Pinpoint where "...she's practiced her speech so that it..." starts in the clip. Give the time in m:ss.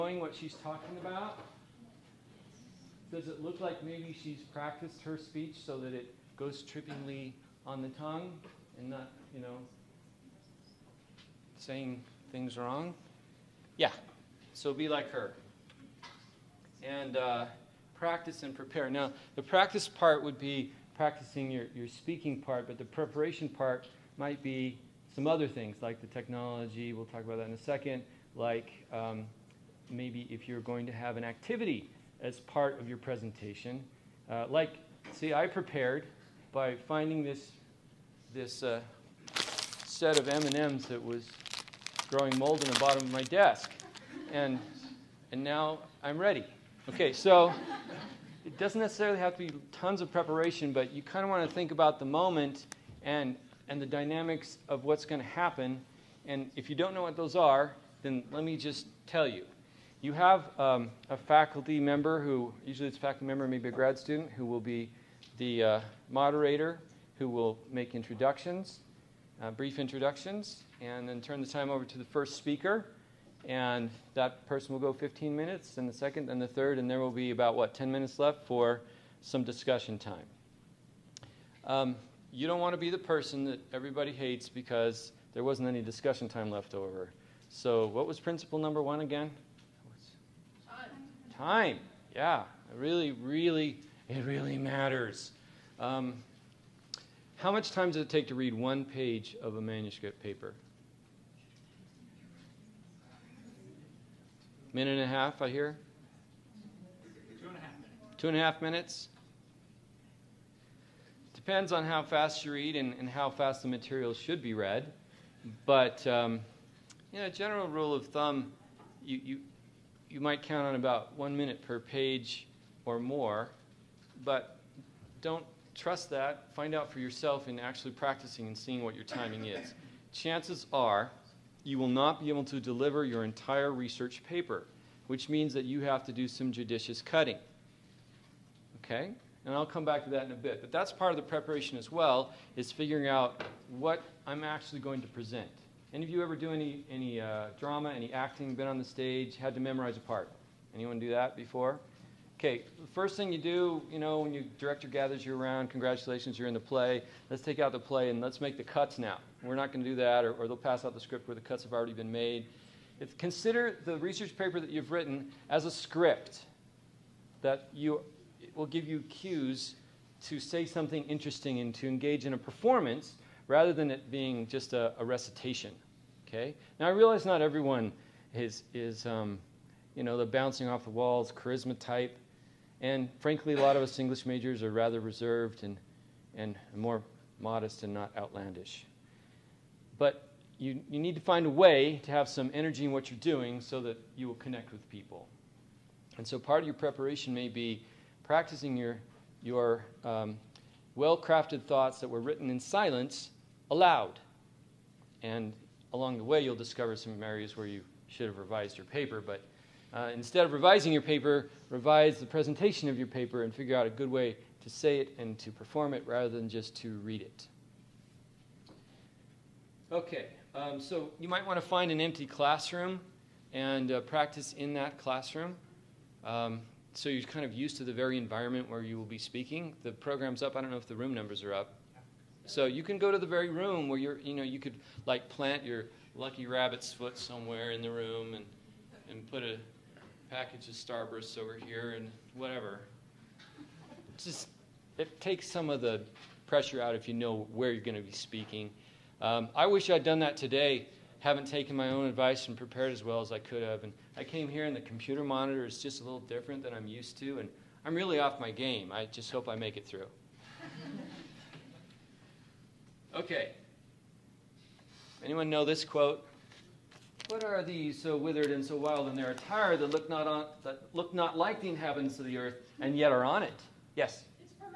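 0:04.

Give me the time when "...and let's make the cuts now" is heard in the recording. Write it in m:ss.
2:38.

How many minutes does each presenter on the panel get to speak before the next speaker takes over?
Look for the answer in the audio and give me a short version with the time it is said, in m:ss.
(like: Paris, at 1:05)
15, at 1:14.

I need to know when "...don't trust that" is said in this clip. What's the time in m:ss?
2:05.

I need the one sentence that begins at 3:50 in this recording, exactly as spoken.
I don't know if the room numbers are up.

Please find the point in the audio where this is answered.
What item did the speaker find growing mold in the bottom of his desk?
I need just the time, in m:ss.
0:40.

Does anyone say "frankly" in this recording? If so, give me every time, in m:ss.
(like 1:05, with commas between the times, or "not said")
3:03.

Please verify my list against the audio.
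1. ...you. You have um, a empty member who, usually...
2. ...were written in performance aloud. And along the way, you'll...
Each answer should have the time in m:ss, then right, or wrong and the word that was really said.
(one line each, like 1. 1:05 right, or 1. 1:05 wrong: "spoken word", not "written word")
1. 0:59 wrong: "faculty", not "empty"
2. 3:22 wrong: "silence", not "performance".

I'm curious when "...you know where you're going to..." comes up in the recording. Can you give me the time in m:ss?
4:07.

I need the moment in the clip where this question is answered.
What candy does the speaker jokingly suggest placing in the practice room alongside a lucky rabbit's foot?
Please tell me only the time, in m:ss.
4:00.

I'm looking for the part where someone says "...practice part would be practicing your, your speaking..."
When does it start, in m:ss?
0:19.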